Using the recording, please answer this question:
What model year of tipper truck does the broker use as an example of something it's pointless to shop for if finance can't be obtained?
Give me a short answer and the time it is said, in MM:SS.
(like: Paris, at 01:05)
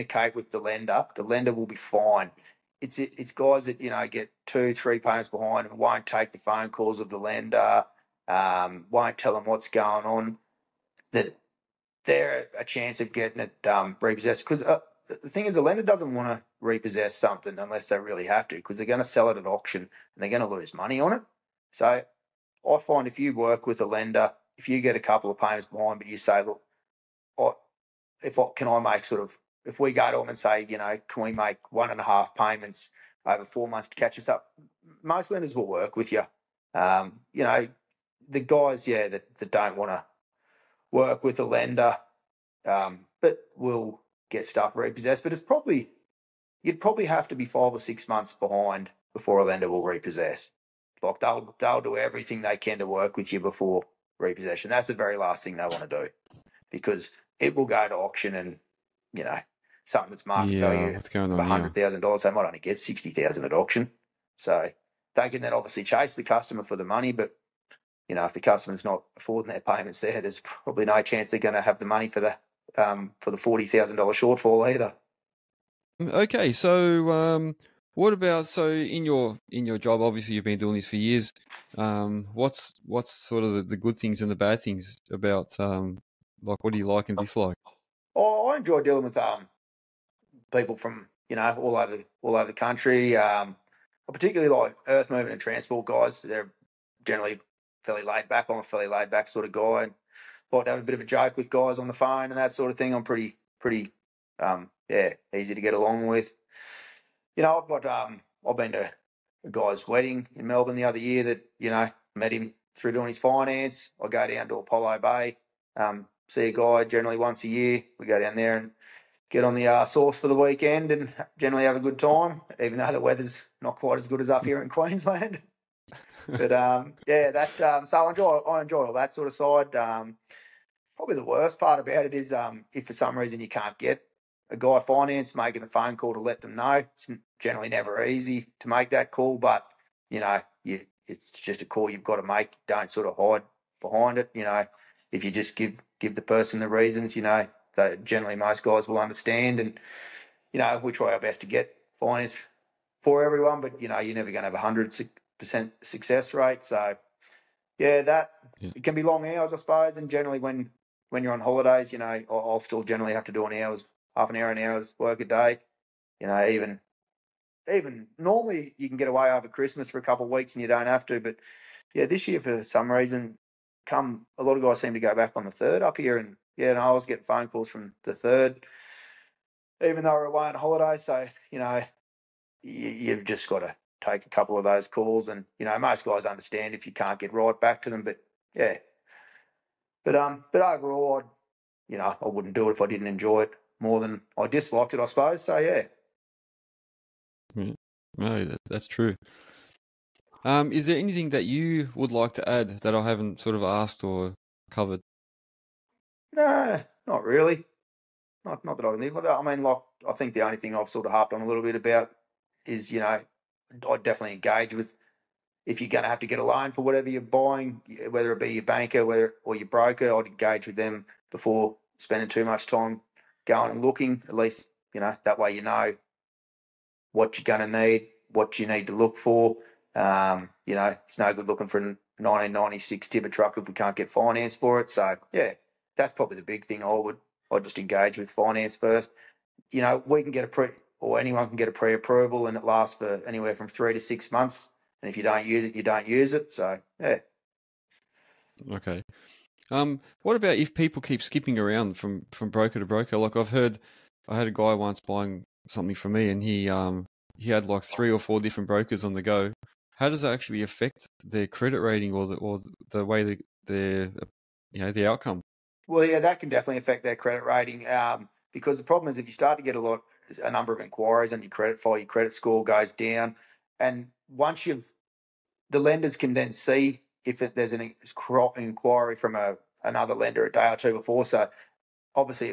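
1996, at 03:52.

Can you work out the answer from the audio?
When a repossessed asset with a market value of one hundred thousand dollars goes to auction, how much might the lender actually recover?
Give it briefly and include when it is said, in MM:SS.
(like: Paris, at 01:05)
$60,000, at 01:02.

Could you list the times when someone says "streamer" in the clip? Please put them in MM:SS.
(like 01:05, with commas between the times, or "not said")
not said.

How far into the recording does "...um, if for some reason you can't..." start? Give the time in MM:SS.
02:12.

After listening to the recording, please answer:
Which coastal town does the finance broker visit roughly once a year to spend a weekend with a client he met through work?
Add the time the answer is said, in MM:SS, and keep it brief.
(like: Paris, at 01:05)
Apollo Bay, at 01:54.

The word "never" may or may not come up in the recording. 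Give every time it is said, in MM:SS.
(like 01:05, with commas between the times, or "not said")
02:17, 02:34.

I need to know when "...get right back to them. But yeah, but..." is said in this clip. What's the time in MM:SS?
03:07.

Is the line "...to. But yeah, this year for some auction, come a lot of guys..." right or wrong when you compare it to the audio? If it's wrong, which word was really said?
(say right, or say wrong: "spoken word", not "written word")
wrong: "reason", not "auction".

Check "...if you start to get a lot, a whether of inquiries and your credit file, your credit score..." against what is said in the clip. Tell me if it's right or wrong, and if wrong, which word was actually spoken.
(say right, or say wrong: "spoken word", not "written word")
wrong: "number", not "whether".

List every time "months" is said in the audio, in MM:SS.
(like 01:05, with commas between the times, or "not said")
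00:33, 00:48, 04:04.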